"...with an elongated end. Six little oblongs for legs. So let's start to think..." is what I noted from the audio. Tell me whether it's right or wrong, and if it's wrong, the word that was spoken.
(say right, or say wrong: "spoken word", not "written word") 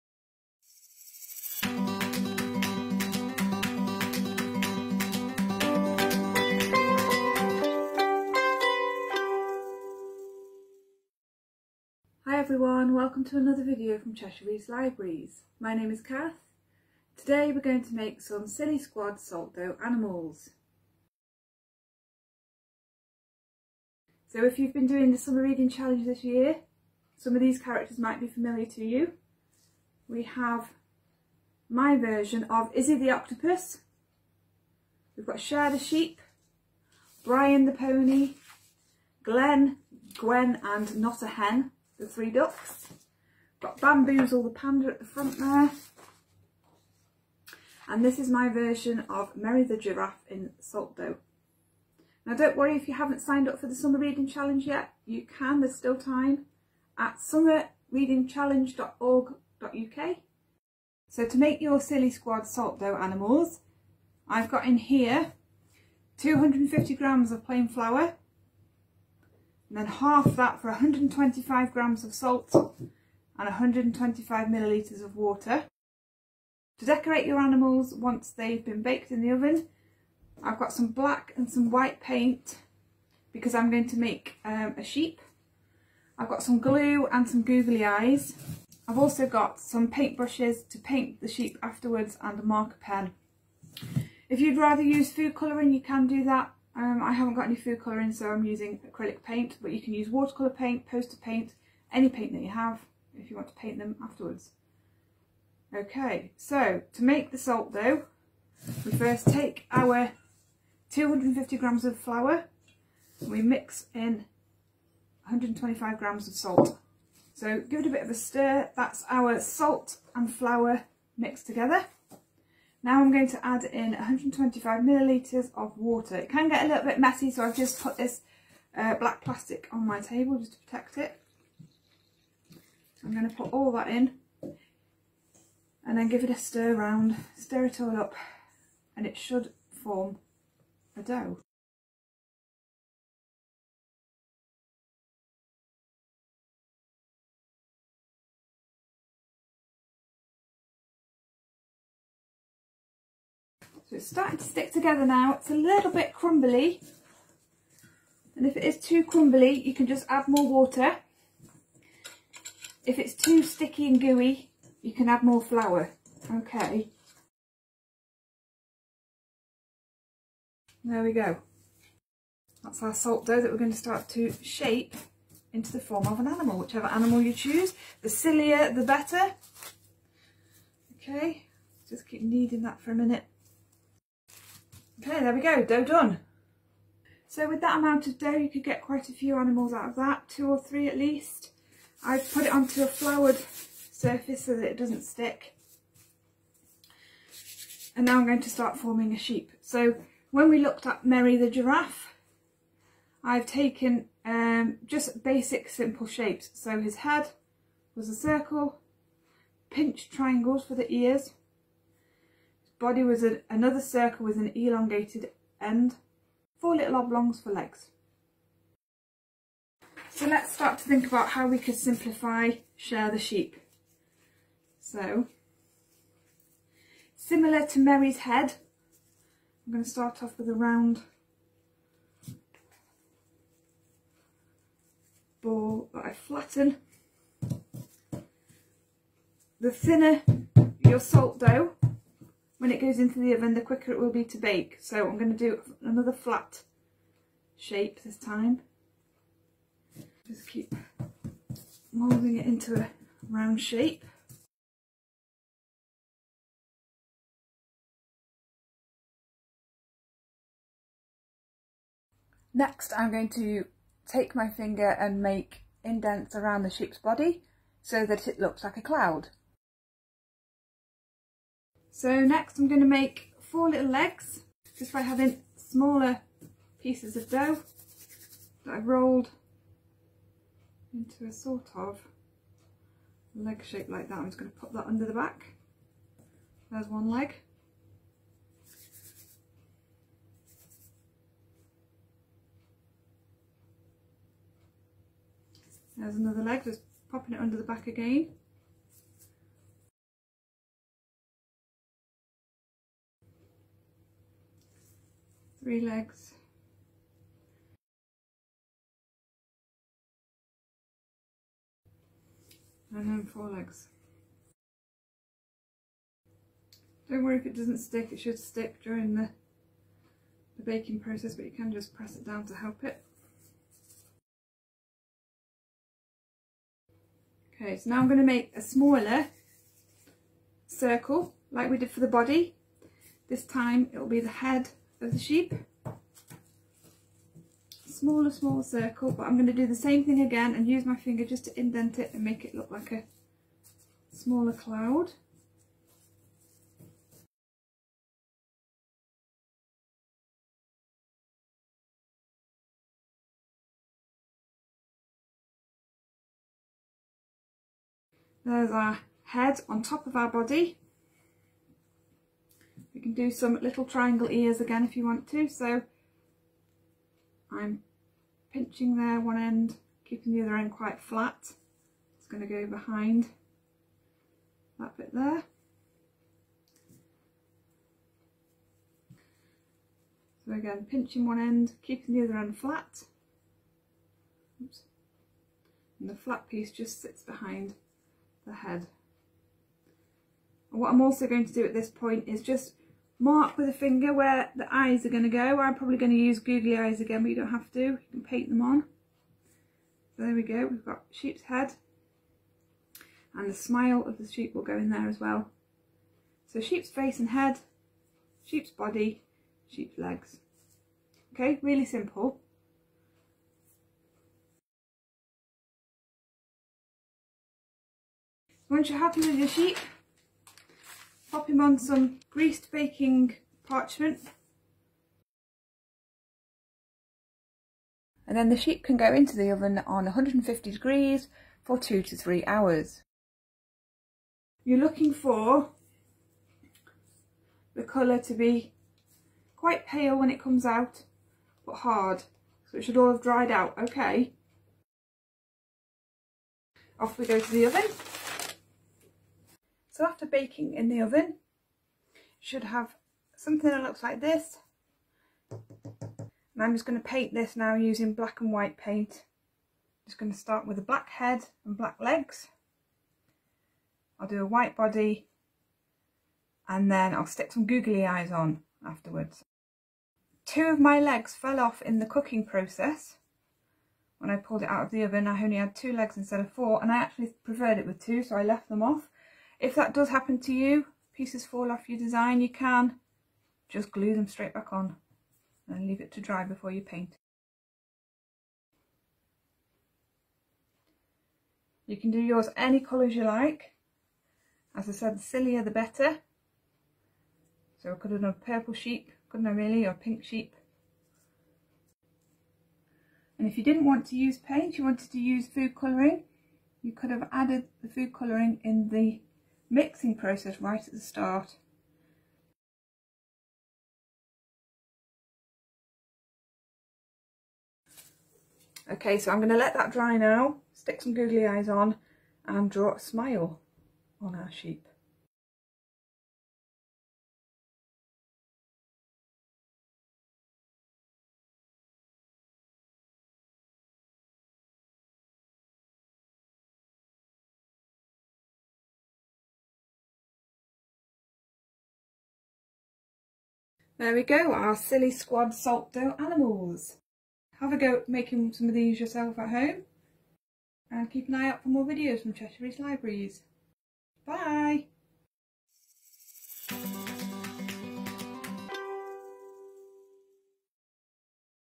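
wrong: "Four", not "Six".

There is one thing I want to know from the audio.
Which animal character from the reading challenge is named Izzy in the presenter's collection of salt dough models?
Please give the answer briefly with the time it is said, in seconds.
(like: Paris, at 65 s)
Octopus, at 32 s.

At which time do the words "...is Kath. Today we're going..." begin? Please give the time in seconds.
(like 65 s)
15 s.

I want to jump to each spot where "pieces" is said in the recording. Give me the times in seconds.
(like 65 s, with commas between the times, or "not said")
276 s, 386 s, 481 s.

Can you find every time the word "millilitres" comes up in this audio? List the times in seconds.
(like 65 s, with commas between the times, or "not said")
74 s, 124 s.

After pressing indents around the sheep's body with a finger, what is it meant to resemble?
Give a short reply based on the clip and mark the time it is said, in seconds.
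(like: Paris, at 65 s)
A cloud, at 268 s.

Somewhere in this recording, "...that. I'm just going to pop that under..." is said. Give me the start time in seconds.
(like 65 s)
284 s.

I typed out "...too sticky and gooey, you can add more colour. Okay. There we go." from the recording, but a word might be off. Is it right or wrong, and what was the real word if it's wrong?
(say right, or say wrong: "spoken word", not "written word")
wrong: "flour", not "colour".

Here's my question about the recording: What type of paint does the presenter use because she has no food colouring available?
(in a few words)
Acrylic paint.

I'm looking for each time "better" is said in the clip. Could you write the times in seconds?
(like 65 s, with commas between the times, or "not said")
178 s, 495 s.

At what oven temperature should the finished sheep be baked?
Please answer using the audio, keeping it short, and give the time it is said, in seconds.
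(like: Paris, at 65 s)
150 degrees, at 430 s.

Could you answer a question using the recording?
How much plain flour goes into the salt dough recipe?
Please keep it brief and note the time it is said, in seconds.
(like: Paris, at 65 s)
250 grams, at 66 s.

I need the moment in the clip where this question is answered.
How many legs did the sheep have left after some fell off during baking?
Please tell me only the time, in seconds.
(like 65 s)
475 s.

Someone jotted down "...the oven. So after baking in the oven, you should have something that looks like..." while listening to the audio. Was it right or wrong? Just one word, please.
right.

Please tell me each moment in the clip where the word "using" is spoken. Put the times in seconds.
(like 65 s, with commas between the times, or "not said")
98 s, 457 s.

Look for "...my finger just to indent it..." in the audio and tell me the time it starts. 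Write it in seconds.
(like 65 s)
340 s.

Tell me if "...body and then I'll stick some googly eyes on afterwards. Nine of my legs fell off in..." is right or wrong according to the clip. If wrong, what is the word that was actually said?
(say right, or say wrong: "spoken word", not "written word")
wrong: "Two", not "Nine".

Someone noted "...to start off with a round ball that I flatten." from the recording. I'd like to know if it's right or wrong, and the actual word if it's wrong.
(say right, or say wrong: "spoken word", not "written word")
right.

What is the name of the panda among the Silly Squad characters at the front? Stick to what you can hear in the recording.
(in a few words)
Bamboozle.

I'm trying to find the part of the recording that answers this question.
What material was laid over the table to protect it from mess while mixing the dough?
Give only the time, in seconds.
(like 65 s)
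128 s.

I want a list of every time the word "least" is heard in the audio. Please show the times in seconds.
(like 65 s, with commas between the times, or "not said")
190 s.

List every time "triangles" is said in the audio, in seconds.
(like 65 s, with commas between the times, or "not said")
210 s, 363 s.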